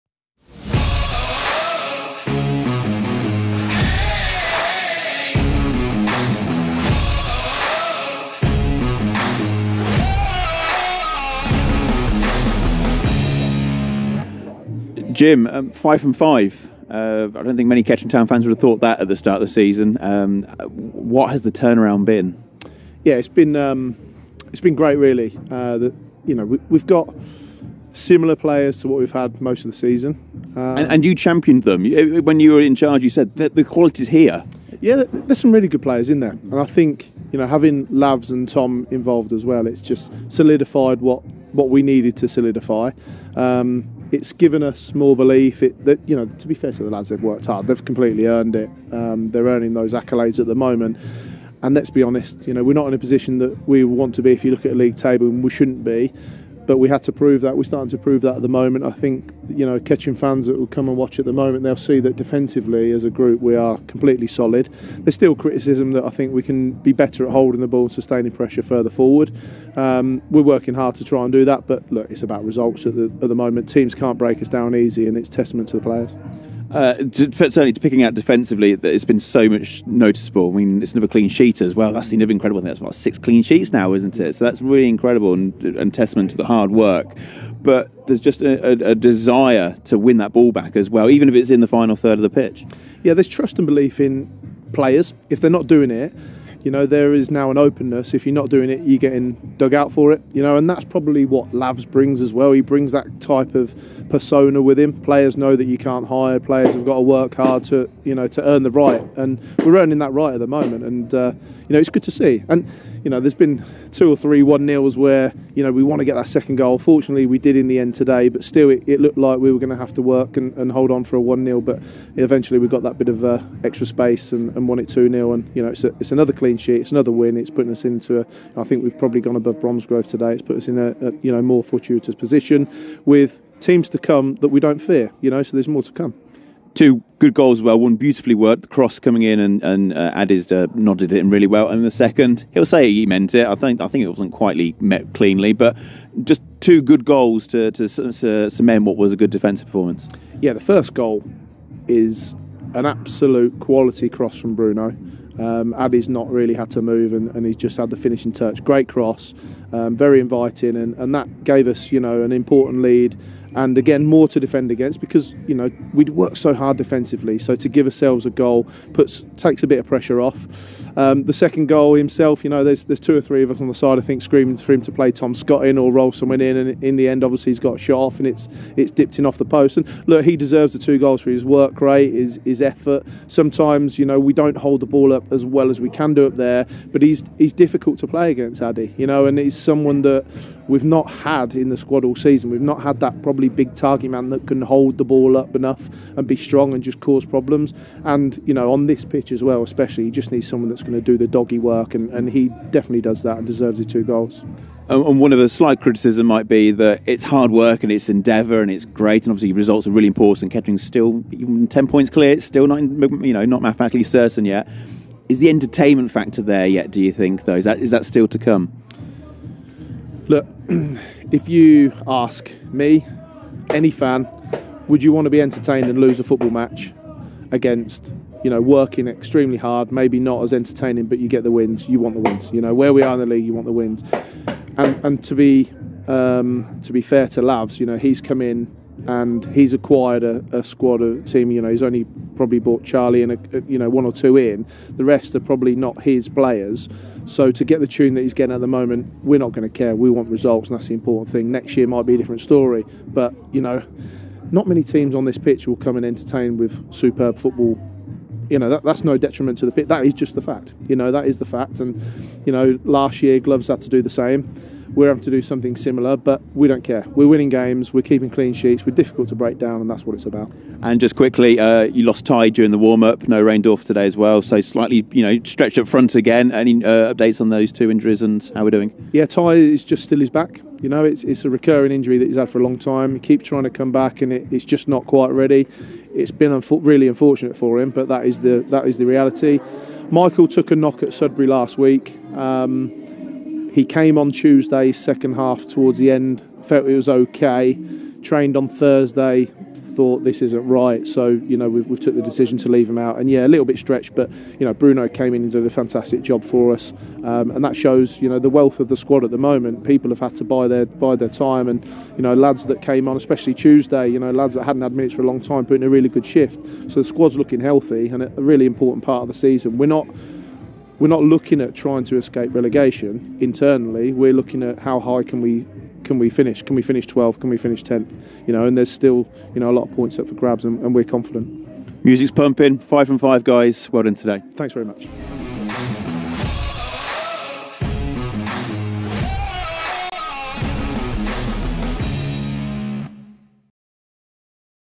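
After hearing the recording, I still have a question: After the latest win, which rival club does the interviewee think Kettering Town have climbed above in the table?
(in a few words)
Bromsgrove.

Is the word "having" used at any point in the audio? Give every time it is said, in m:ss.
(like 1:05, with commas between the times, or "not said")
0:37, 4:25.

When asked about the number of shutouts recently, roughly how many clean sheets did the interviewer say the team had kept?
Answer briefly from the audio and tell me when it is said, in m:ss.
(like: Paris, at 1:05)
6, at 1:22.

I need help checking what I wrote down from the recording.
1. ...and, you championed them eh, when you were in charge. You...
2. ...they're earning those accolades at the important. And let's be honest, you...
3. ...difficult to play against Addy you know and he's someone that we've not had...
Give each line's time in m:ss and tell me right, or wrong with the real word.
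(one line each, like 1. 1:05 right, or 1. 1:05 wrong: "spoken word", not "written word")
1. 0:30 right
2. 0:49 wrong: "moment", not "important"
3. 3:07 right.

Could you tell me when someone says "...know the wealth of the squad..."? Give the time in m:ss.
5:08.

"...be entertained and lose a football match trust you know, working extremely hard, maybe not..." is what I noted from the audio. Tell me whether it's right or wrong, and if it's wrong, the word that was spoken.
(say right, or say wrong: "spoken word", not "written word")
wrong: "against", not "trust".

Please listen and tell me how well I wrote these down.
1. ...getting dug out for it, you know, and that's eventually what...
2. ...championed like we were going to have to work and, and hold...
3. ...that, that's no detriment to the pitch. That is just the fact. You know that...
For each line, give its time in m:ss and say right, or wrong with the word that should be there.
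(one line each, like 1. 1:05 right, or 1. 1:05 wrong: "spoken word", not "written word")
1. 1:38 wrong: "probably", not "eventually"
2. 1:58 wrong: "looked", not "championed"
3. 4:18 right.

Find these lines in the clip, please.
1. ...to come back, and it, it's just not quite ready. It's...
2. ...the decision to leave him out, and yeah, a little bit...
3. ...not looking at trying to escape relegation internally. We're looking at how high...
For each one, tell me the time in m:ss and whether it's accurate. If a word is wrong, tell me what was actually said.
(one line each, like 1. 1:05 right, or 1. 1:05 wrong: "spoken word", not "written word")
1. 4:43 right
2. 5:02 right
3. 5:21 right.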